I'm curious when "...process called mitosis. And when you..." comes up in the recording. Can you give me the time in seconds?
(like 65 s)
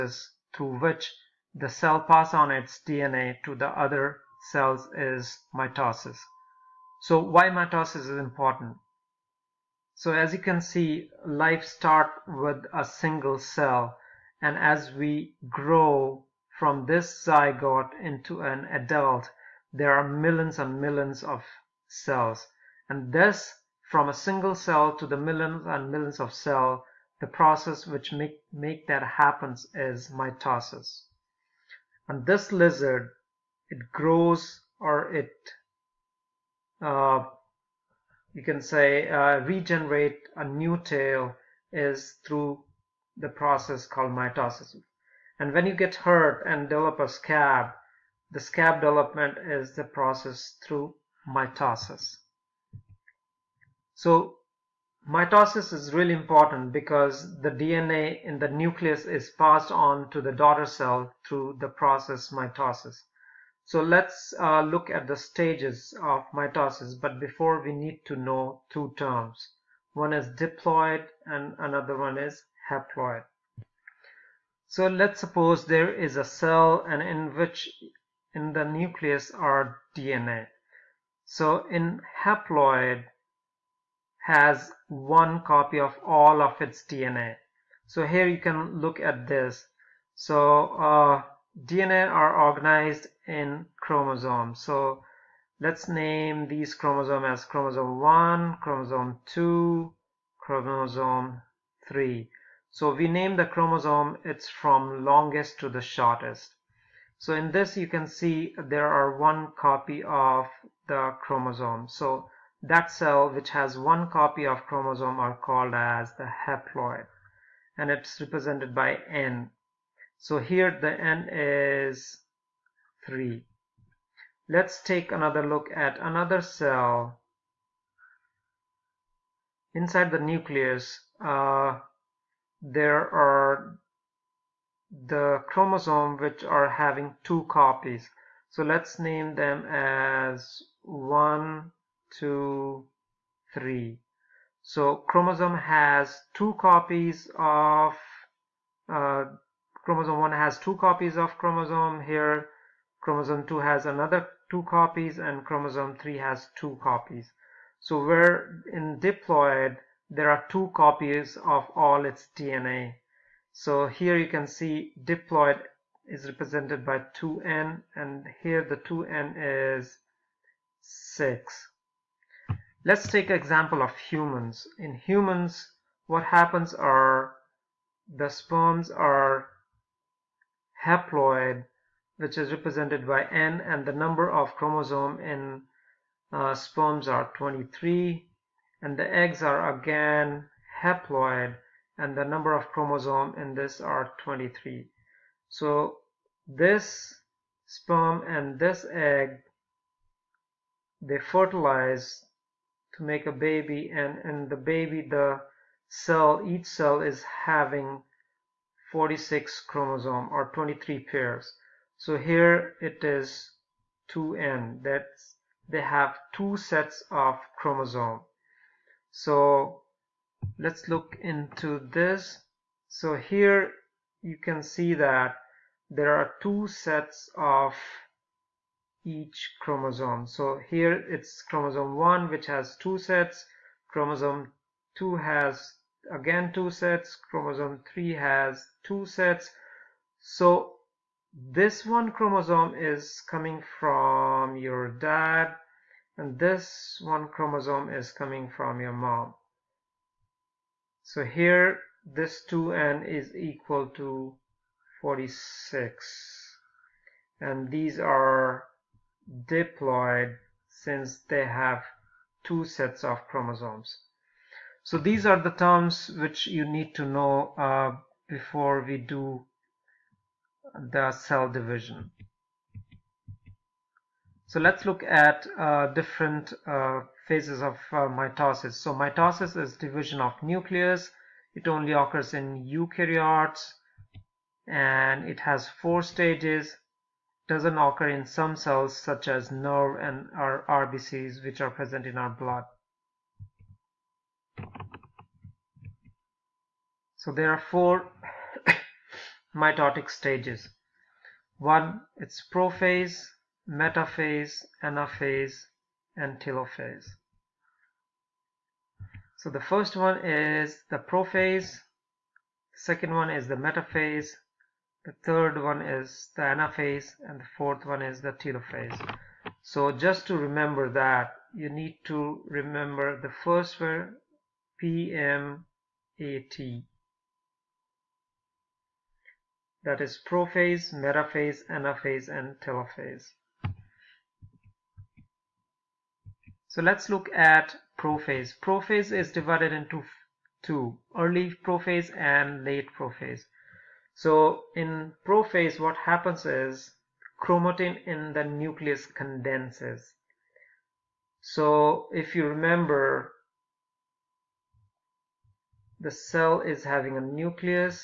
43 s.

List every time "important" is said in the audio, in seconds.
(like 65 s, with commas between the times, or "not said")
8 s, 56 s.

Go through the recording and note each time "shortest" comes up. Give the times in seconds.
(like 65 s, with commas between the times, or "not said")
105 s.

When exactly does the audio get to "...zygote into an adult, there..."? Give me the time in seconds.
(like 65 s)
17 s.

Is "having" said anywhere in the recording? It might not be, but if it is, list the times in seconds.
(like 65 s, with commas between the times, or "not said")
136 s, 207 s, 356 s.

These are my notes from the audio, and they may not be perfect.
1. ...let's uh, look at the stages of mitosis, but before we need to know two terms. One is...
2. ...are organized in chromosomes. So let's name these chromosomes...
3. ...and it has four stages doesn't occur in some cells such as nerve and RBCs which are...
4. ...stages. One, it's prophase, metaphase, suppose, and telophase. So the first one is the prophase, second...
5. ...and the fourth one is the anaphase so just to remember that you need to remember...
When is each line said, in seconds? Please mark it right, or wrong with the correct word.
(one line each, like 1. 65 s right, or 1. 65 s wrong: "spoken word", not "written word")
1. 63 s right
2. 92 s right
3. 284 s right
4. 300 s wrong: "anaphase", not "suppose"
5. 317 s wrong: "telophase", not "anaphase".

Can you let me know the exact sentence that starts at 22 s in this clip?
And this, from a single cell to the millions and millions of cells, the process which make, make that happens is mitosis.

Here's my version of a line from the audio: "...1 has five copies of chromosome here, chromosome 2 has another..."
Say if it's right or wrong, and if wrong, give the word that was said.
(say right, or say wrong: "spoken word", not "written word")
wrong: "two", not "five".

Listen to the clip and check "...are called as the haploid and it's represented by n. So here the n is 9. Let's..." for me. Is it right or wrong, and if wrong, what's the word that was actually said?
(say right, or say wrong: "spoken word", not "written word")
wrong: "3", not "9".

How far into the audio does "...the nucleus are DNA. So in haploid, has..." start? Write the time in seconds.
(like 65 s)
78 s.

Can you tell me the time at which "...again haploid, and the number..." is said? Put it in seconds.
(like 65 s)
189 s.